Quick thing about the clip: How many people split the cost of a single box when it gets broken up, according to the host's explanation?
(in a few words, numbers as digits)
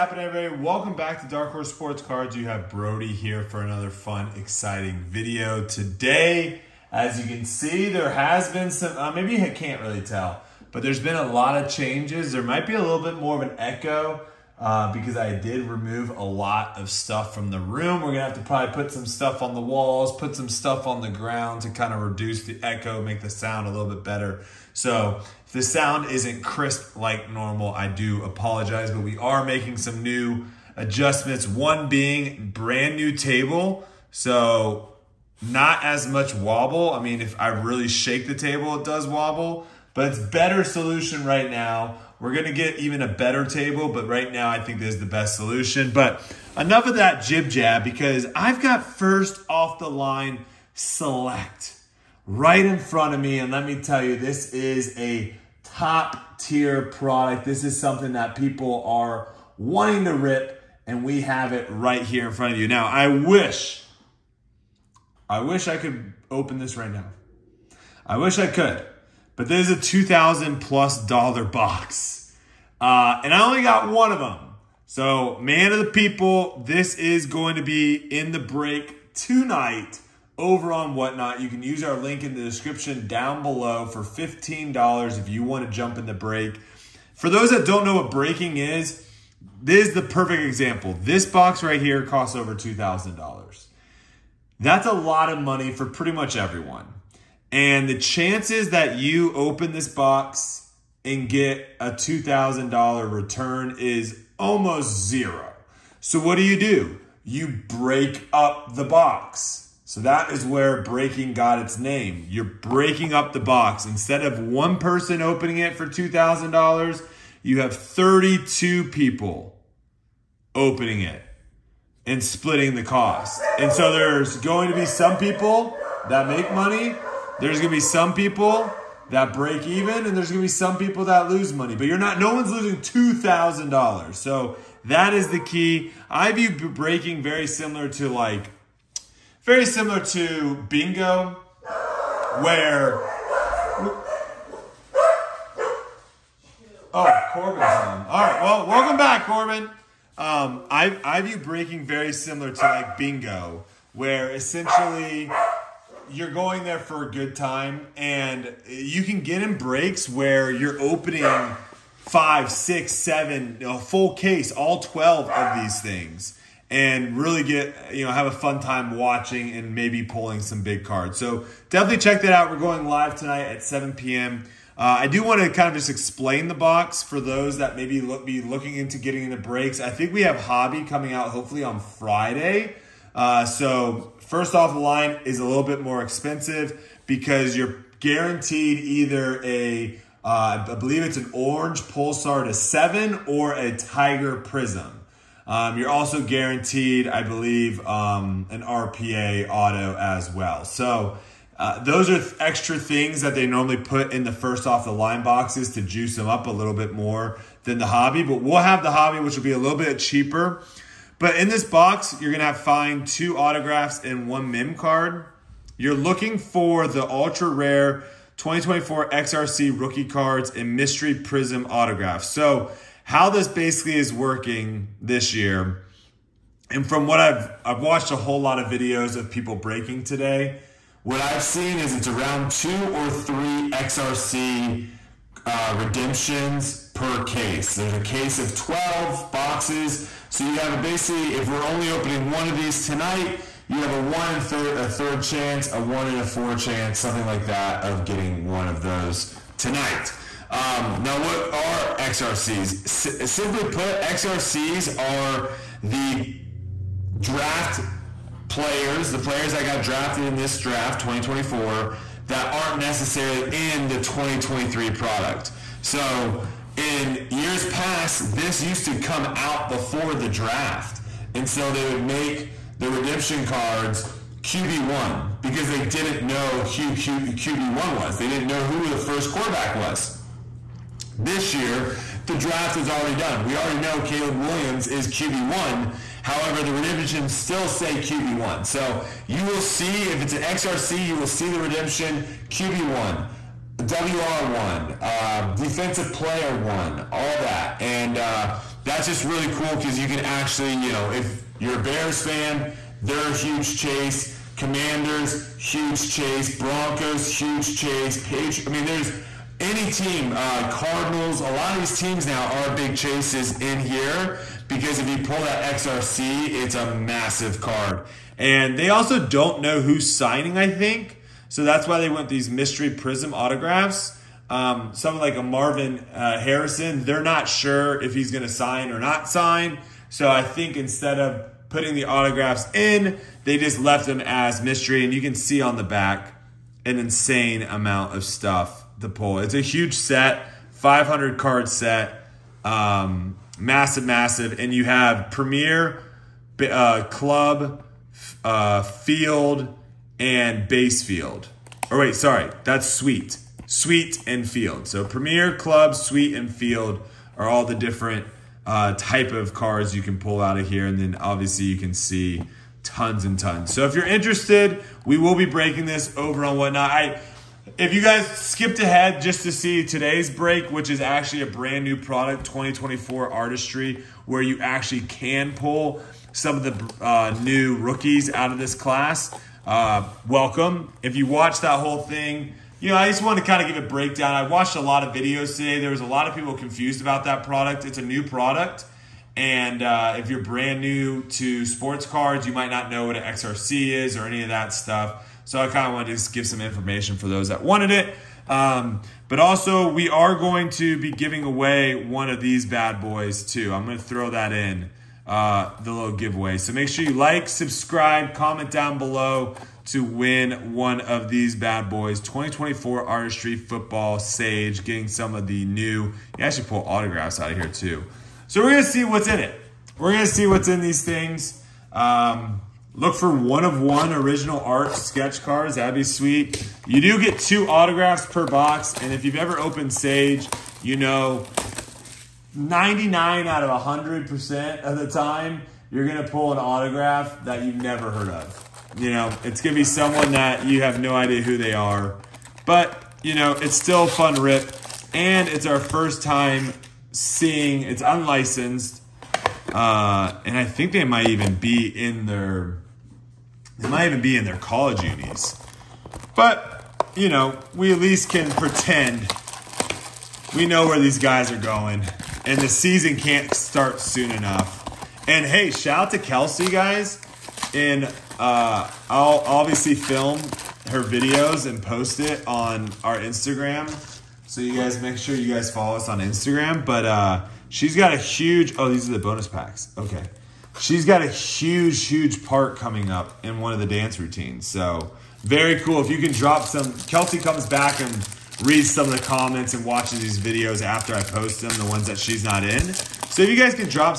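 32.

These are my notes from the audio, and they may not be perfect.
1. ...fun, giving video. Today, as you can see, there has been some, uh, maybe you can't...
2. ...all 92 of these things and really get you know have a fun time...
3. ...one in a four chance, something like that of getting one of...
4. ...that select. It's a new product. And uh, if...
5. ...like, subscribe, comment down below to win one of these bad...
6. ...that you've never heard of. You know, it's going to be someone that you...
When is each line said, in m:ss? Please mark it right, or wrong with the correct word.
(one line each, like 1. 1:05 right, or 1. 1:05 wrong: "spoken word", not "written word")
1. 0:03 wrong: "exciting", not "giving"
2. 2:44 wrong: "12", not "92"
3. 4:05 right
4. 6:27 wrong: "product", not "select"
5. 6:47 right
6. 7:17 right.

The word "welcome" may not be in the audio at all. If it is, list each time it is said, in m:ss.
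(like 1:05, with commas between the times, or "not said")
0:00, 2:28, 6:20.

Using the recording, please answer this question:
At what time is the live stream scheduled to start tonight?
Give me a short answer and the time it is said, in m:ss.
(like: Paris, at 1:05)
7 p.m., at 2:53.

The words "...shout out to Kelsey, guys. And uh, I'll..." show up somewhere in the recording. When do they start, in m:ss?
7:45.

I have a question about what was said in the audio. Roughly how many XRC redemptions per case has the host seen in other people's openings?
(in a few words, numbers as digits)
two or three.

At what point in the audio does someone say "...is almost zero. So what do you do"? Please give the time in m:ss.
1:43.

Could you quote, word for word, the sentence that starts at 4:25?
So, in years past, this used to come out before the draft.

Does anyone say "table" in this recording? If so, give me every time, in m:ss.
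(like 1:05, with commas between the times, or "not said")
0:33, 0:38, 0:43.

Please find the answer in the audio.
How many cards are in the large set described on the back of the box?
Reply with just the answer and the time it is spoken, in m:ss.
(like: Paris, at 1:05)
500, at 5:40.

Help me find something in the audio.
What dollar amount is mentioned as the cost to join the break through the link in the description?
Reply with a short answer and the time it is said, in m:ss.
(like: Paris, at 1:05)
$15, at 1:24.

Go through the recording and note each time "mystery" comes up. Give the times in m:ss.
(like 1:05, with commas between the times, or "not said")
3:40, 5:22, 5:34.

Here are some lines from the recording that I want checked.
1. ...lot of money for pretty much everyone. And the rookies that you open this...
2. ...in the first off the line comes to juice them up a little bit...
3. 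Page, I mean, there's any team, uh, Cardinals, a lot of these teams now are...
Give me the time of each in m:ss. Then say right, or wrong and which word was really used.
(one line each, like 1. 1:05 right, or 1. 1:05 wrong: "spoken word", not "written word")
1. 1:34 wrong: "chances", not "rookies"
2. 3:24 wrong: "boxes", not "comes"
3. 5:08 right.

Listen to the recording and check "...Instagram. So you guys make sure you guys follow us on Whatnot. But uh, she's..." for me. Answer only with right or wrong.
wrong.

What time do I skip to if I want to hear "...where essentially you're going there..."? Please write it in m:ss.
2:33.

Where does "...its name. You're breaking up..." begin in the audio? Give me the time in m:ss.
1:51.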